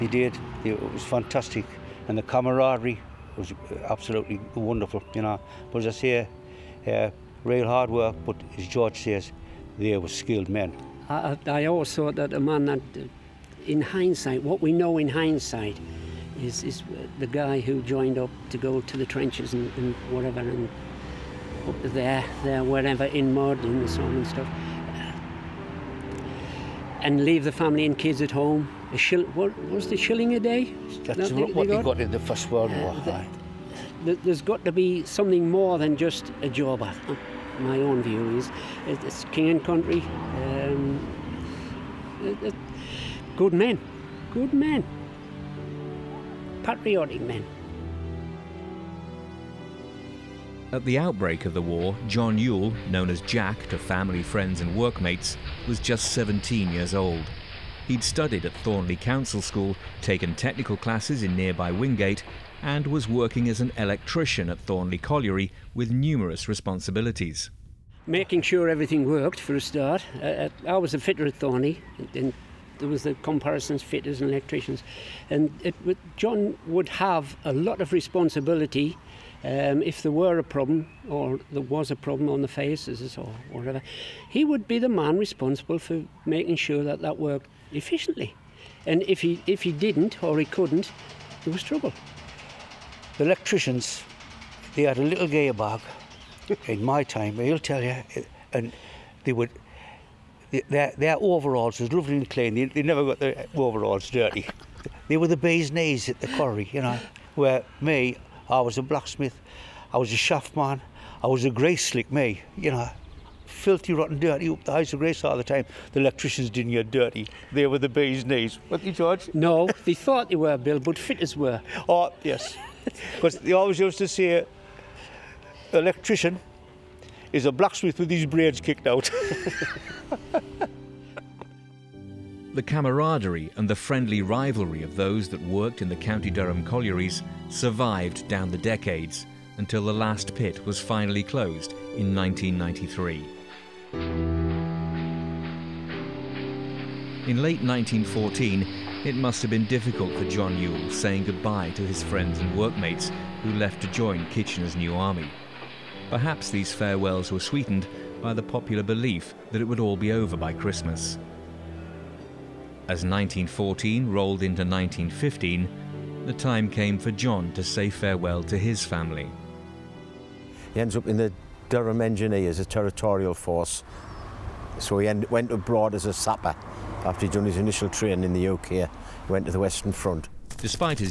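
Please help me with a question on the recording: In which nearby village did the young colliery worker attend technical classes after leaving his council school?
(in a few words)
Wingate.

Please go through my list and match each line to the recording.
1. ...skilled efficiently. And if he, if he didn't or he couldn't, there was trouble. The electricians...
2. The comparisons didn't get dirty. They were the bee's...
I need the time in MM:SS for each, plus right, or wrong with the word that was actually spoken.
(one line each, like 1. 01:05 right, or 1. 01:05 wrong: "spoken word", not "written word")
1. 01:27 wrong: "worked", not "skilled"
2. 01:55 wrong: "electricians", not "comparisons".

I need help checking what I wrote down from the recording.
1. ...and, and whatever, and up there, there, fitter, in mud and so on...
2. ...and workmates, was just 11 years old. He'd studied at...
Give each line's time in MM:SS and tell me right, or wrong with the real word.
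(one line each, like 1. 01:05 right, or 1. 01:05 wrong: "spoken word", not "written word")
1. 00:19 wrong: "wherever", not "fitter"
2. 00:54 wrong: "17", not "11".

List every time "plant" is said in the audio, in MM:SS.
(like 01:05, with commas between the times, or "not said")
not said.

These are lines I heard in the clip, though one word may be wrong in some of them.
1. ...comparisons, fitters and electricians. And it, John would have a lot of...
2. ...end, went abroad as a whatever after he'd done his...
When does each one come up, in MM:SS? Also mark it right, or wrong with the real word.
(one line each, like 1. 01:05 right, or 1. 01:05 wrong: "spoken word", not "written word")
1. 01:13 right
2. 02:55 wrong: "sapper", not "whatever".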